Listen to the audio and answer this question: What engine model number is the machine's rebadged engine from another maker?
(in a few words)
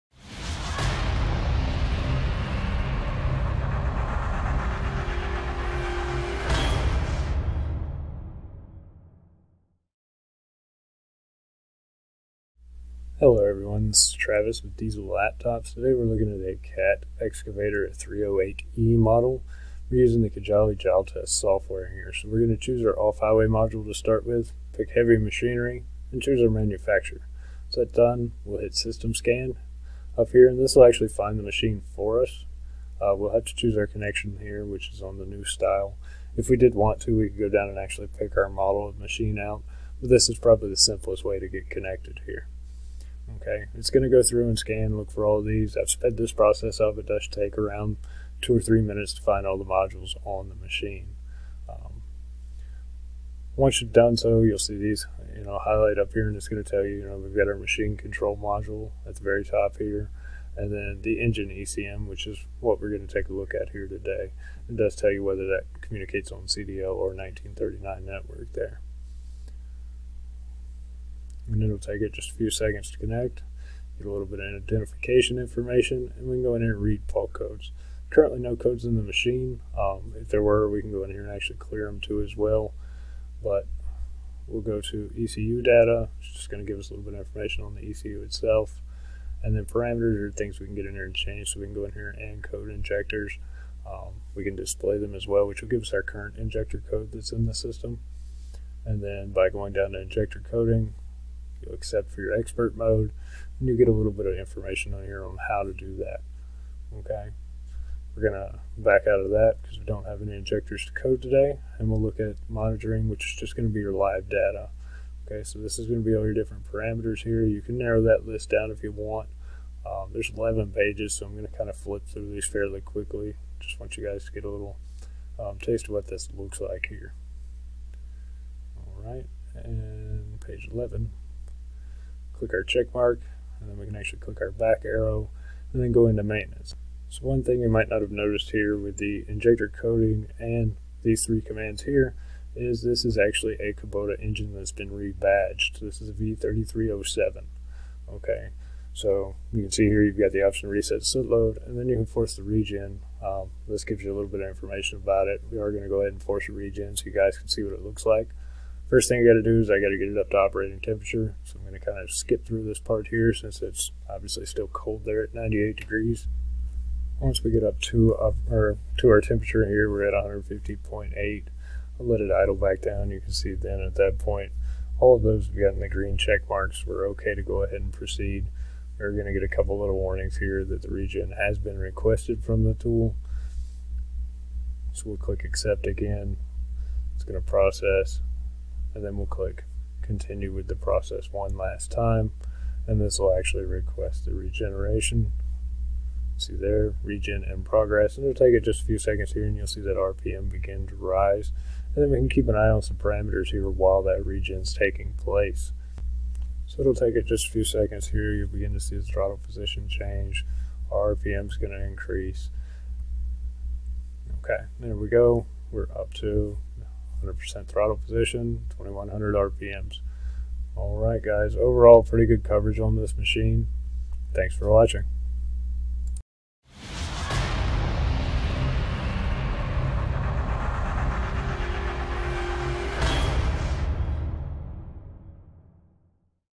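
V3307.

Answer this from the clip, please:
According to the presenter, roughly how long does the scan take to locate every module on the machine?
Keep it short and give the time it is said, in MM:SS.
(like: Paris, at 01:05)
2 or 3 minutes, at 00:48.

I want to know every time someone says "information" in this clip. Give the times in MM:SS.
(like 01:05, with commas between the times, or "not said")
01:15, 01:27, 01:44, 02:34.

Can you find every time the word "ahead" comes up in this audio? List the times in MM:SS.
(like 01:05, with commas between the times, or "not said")
02:36, 02:57.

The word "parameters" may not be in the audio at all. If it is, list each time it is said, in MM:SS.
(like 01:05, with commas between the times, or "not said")
01:29, 01:56, 03:22.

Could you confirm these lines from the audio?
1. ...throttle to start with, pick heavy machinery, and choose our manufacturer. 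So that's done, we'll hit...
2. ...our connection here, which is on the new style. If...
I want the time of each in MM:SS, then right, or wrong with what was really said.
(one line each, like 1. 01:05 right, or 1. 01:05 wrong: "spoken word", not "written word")
1. 00:23 wrong: "module", not "throttle"
2. 00:33 right.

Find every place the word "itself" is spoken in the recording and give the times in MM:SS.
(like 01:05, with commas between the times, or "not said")
01:28.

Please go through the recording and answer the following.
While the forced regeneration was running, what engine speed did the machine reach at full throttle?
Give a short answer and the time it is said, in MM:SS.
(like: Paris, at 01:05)
2100 RPM, at 03:38.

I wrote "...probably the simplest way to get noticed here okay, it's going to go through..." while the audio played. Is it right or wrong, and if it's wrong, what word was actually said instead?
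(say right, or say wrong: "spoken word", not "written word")
wrong: "connected", not "noticed".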